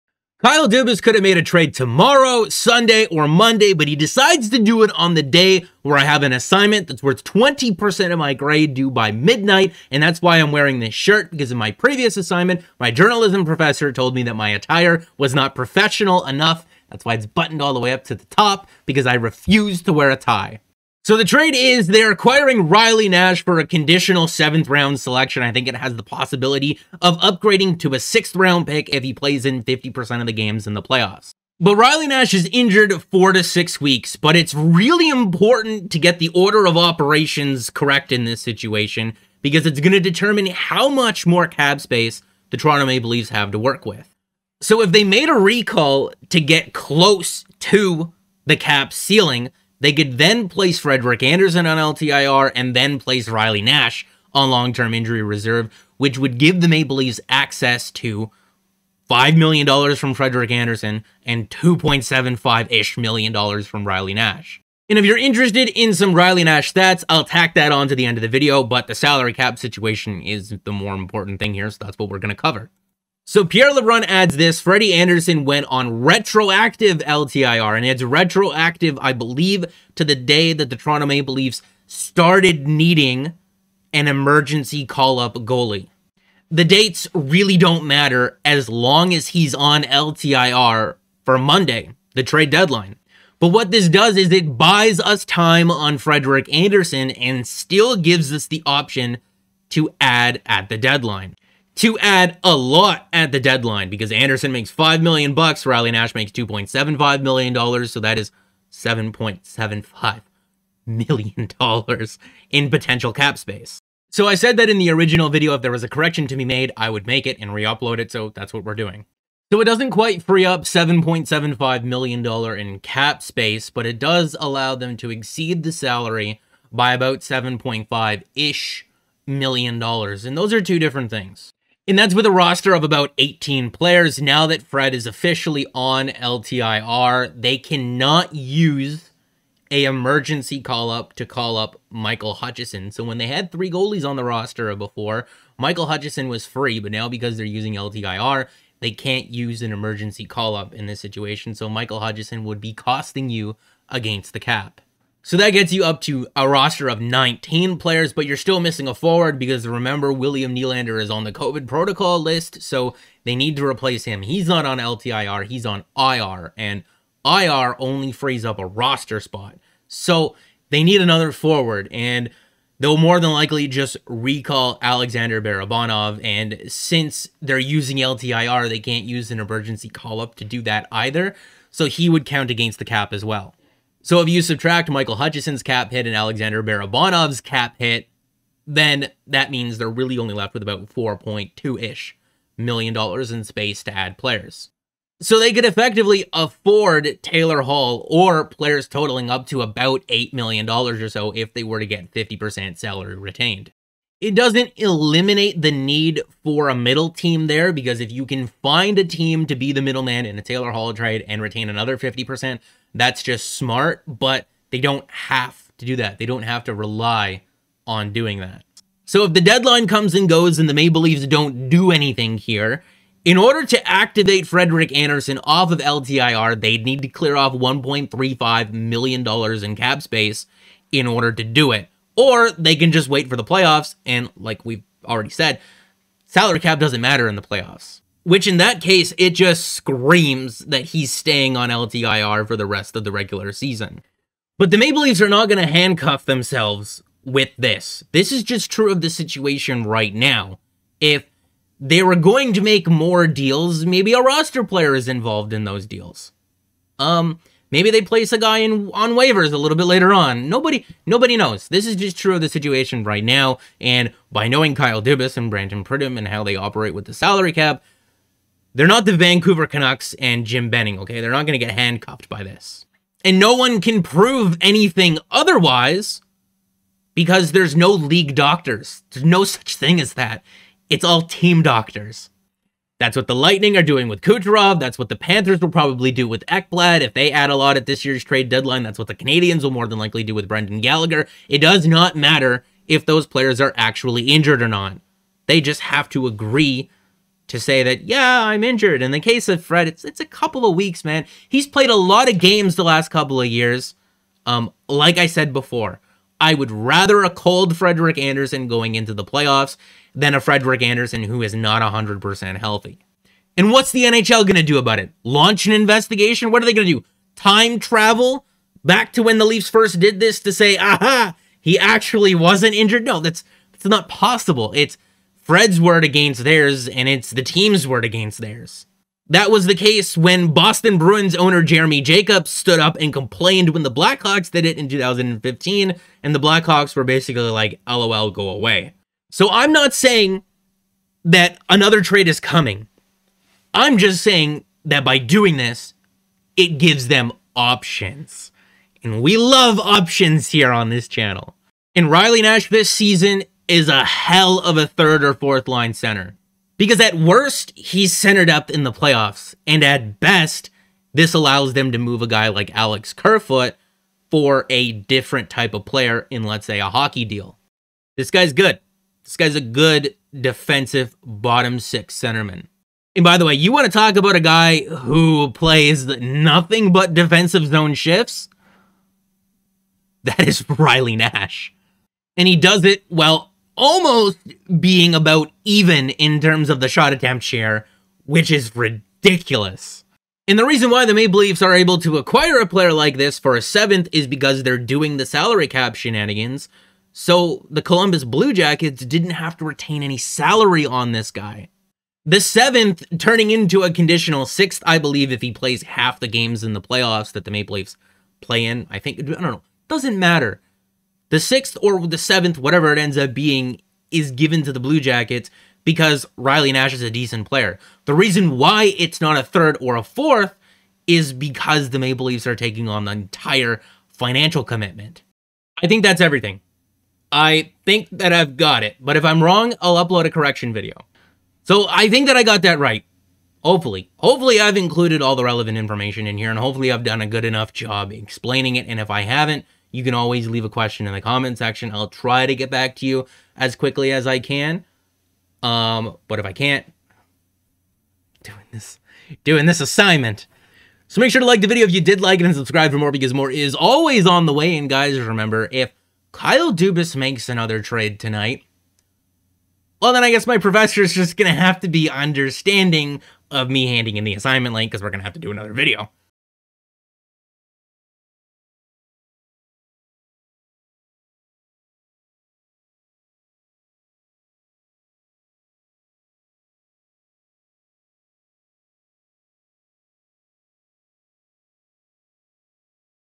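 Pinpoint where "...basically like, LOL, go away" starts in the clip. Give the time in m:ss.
5:37.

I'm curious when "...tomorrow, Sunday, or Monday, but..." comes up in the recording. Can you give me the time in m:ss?
0:01.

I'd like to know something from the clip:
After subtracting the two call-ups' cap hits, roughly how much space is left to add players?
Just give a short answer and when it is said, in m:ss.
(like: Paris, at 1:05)
$4.2 million, at 3:10.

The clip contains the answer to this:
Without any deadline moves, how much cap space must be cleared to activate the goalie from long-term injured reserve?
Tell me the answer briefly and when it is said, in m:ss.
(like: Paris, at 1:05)
$1.35 million, at 3:47.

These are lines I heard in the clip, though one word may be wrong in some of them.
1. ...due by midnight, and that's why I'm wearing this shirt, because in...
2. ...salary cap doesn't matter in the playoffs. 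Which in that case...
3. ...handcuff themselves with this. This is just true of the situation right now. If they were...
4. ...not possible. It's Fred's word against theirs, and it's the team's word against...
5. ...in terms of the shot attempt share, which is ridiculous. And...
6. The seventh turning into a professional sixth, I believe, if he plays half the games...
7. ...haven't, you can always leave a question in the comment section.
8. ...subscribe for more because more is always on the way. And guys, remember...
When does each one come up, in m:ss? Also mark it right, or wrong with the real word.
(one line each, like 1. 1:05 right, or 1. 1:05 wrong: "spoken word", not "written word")
1. 0:08 right
2. 3:56 right
3. 4:05 right
4. 5:23 right
5. 6:26 right
6. 6:42 wrong: "conditional", not "professional"
7. 7:19 right
8. 7:32 right.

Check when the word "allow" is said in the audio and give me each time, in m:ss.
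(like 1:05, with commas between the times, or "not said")
2:04, 6:01.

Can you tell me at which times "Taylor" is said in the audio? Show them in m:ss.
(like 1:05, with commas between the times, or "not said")
3:17, 3:30.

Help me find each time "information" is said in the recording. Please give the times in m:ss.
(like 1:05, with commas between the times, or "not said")
7:15.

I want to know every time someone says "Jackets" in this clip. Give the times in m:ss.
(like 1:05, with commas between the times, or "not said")
6:38, 6:54.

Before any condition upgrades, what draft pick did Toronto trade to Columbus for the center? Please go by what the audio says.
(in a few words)
Conditional seventh round selection.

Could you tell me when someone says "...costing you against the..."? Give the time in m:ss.
2:32.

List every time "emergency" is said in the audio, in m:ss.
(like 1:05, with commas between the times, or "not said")
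1:24, 2:19, 2:29, 2:59.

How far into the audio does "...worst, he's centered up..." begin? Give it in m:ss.
5:57.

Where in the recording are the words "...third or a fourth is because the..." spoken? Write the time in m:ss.
6:59.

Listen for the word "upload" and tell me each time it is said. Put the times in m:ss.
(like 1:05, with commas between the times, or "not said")
1:57, 7:10.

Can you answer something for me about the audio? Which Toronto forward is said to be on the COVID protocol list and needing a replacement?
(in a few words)
William Nylander.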